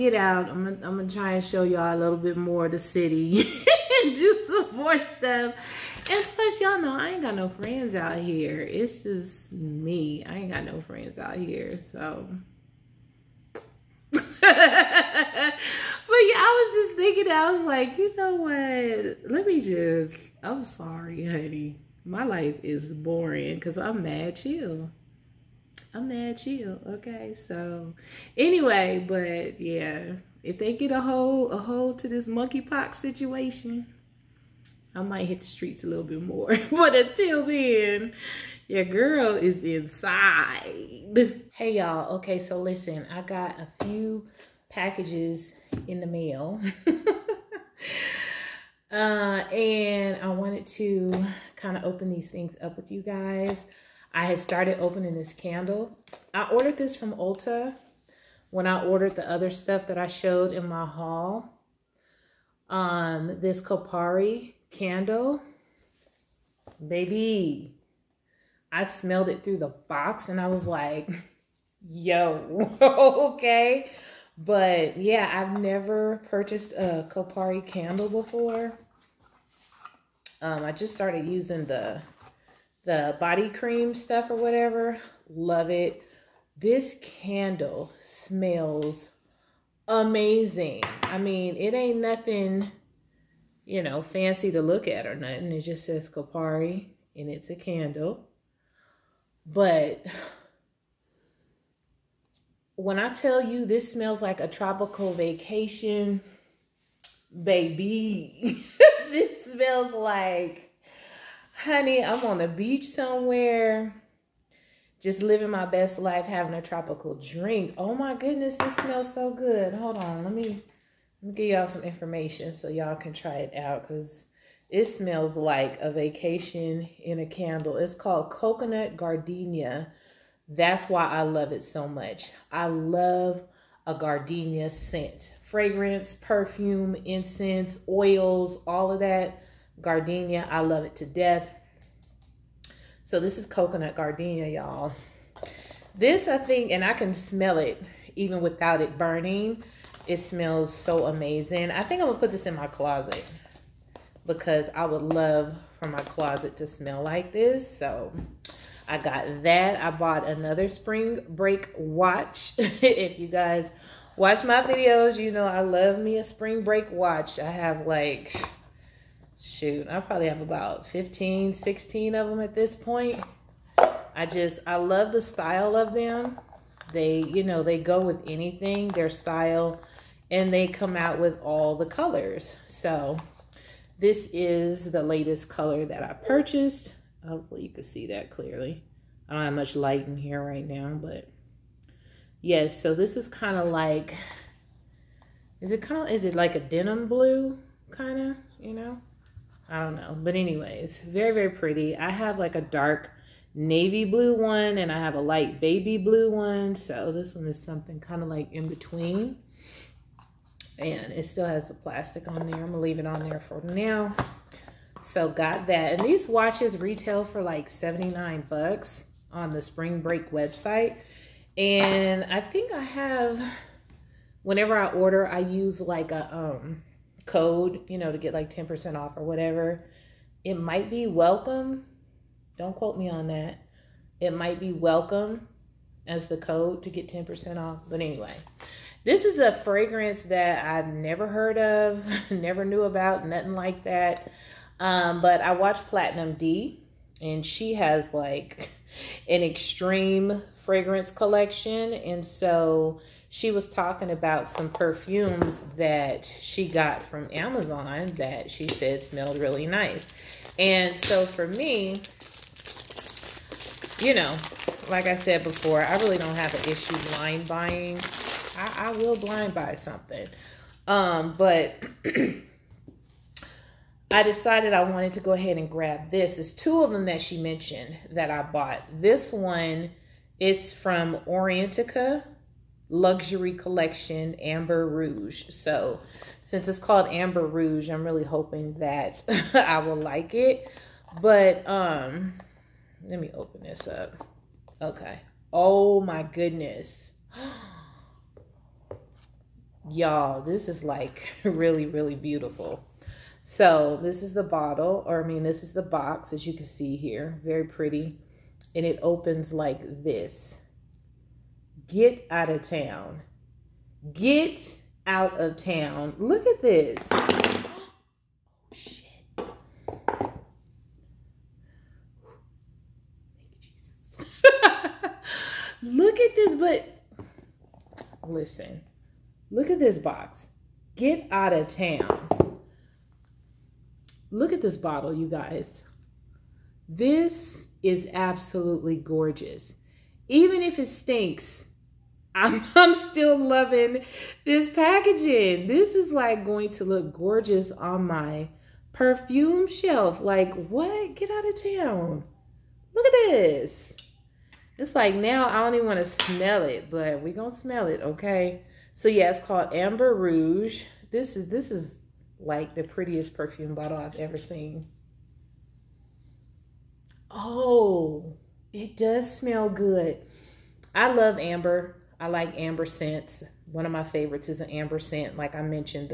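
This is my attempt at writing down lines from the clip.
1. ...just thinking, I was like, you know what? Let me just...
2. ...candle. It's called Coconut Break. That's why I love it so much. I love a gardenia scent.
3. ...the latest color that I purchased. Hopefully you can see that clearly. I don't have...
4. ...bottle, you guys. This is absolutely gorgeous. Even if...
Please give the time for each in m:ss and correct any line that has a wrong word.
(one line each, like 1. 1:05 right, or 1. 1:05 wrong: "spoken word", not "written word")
1. 0:16 right
2. 2:07 wrong: "Gardenia", not "Break"
3. 3:04 right
4. 5:34 right.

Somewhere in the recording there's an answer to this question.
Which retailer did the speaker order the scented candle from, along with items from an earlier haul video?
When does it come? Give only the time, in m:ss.
0:57.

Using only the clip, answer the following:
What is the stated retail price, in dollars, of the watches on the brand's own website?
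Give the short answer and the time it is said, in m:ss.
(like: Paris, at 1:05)
79, at 3:37.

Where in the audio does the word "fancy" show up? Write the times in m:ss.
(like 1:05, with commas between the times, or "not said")
1:34.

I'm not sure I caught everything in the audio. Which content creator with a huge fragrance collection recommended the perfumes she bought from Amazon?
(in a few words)
Platinum D.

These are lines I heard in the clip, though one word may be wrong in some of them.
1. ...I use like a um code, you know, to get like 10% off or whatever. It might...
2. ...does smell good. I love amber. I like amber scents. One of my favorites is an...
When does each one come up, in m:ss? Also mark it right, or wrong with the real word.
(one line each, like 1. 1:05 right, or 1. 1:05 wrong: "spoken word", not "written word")
1. 3:45 right
2. 6:08 right.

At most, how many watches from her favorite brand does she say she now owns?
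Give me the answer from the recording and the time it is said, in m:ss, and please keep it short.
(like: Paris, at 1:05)
16, at 2:51.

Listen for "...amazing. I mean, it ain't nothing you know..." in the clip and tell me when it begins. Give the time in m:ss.
1:29.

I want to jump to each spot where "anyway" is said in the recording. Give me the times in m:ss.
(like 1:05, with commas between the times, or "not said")
0:28, 3:20, 3:58.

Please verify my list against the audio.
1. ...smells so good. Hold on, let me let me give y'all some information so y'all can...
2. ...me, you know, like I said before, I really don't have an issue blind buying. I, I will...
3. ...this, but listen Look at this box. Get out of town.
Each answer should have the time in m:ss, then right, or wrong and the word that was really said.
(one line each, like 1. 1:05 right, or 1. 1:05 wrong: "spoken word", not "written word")
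1. 1:58 right
2. 4:21 right
3. 5:26 right.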